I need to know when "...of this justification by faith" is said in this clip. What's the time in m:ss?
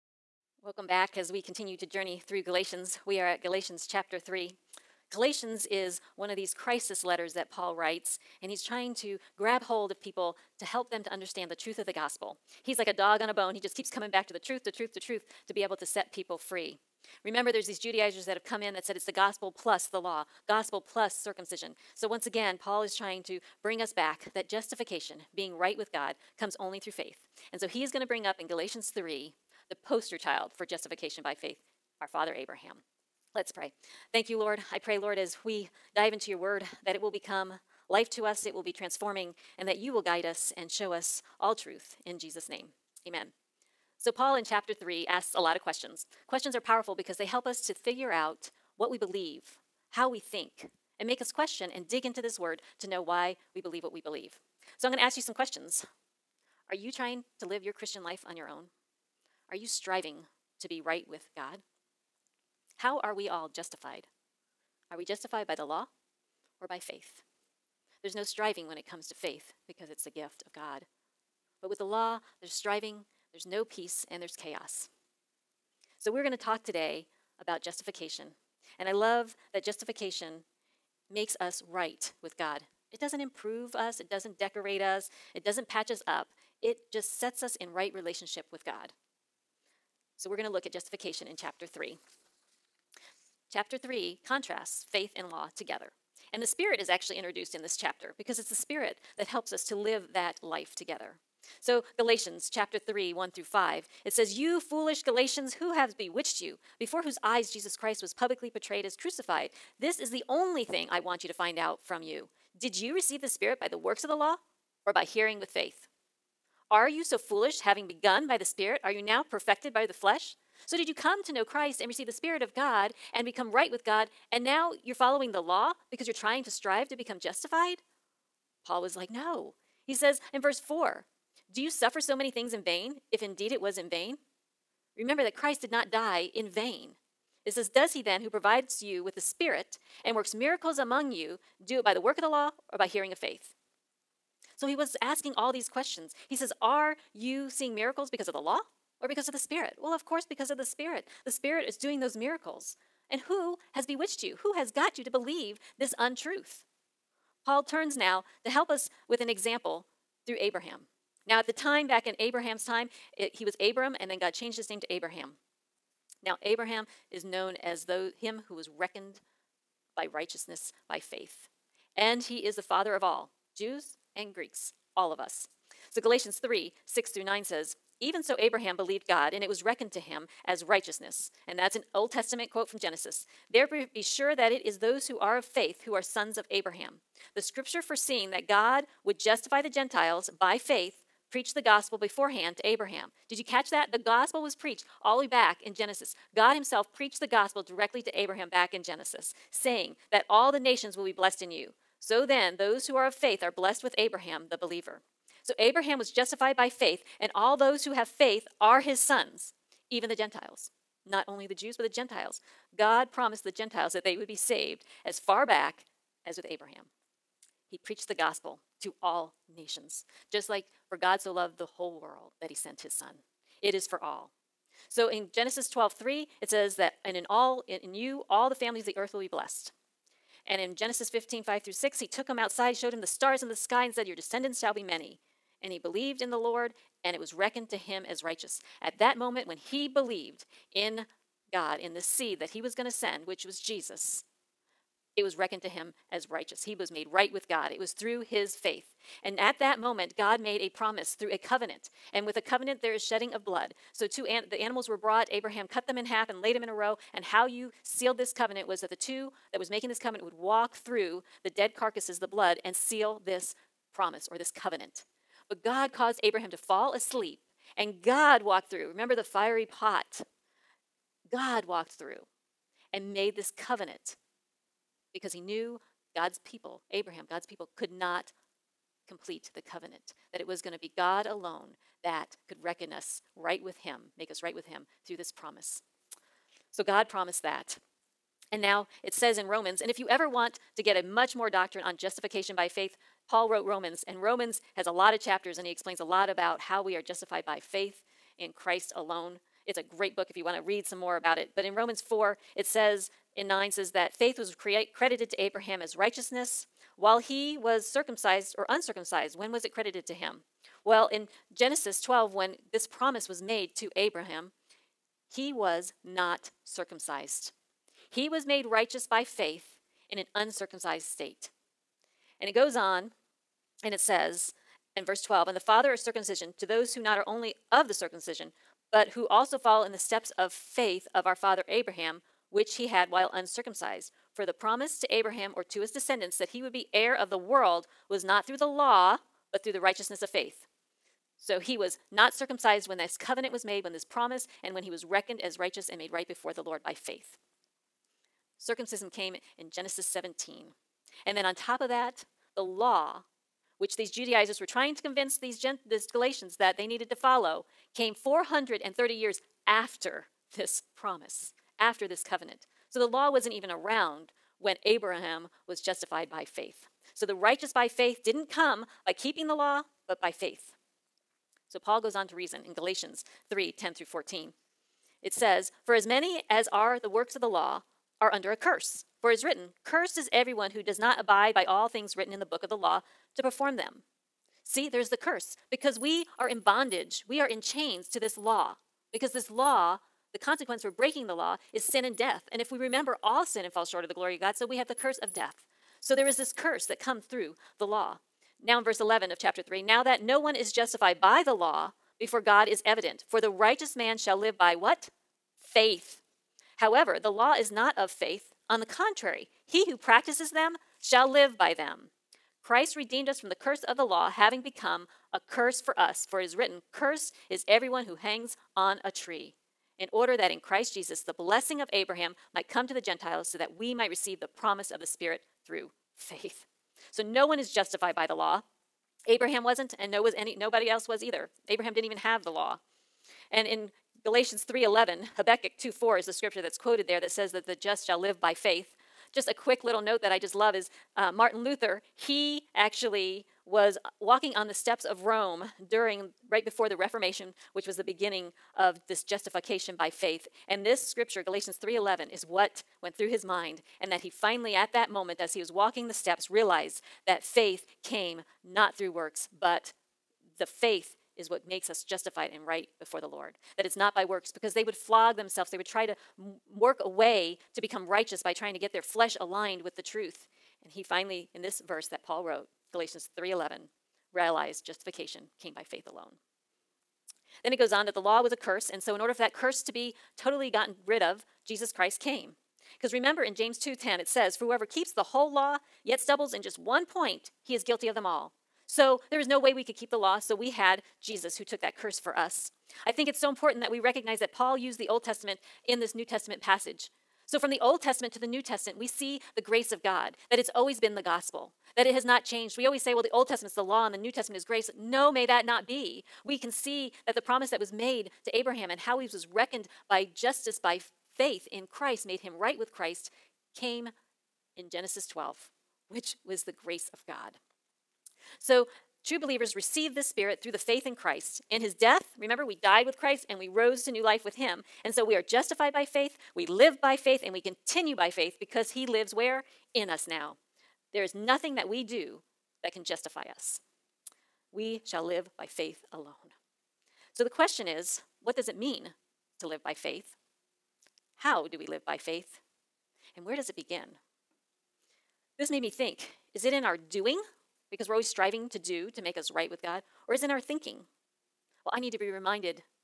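7:28.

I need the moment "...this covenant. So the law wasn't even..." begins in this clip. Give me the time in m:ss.
6:02.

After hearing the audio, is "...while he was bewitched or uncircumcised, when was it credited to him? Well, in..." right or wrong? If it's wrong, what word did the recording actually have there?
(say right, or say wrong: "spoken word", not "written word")
wrong: "circumcised", not "bewitched".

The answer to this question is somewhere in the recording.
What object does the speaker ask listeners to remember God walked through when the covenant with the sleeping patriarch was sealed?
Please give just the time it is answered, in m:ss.
4:29.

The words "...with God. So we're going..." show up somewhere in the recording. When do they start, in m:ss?
1:28.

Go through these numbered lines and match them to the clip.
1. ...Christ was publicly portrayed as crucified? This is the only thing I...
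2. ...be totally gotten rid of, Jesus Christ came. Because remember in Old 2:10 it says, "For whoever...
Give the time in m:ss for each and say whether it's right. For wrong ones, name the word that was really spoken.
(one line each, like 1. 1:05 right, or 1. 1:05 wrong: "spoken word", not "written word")
1. 1:47 right
2. 7:59 wrong: "James", not "Old".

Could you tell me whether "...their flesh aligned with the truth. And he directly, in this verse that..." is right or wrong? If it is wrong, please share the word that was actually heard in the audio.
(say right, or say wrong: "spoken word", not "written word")
wrong: "finally", not "directly".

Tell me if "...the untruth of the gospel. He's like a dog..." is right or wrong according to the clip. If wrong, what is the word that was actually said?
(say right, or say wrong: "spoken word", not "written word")
wrong: "truth", not "untruth".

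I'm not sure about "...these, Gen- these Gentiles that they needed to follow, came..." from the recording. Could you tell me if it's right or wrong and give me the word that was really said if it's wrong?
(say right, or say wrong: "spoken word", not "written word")
wrong: "Galatians", not "Gentiles".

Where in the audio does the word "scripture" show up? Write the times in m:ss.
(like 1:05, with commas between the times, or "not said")
3:07, 7:16, 7:31.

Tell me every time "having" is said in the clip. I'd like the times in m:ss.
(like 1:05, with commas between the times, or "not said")
1:57, 6:54.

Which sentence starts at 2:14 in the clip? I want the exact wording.
Remember that Christ did not die in vain.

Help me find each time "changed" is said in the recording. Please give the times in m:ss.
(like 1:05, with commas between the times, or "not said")
2:44, 8:22.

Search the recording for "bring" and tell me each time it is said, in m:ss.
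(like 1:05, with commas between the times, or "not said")
0:23, 0:28.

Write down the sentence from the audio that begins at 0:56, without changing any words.
Are you trying to live your Christian life on your own?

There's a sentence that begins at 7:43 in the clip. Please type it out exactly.
That it's not by works, because they would flog themselves.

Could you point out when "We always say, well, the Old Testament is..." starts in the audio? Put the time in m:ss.
8:22.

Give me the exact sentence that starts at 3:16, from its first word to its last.
God Himself preached the gospel directly to Abraham back in Genesis, saying that all the nations will be blessed in you.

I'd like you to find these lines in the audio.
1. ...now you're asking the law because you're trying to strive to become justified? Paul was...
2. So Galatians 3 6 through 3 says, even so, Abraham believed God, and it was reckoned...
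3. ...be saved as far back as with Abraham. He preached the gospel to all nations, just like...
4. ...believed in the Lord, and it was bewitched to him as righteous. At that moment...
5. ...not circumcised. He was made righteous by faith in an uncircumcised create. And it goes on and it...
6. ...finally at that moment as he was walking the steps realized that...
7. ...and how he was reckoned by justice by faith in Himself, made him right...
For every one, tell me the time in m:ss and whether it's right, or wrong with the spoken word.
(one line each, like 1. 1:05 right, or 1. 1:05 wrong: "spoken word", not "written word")
1. 2:04 wrong: "following", not "asking"
2. 2:55 wrong: "9", not "3"
3. 3:34 right
4. 3:55 wrong: "reckoned", not "bewitched"
5. 5:16 wrong: "state", not "create"
6. 7:34 right
7. 8:28 wrong: "Christ", not "Himself".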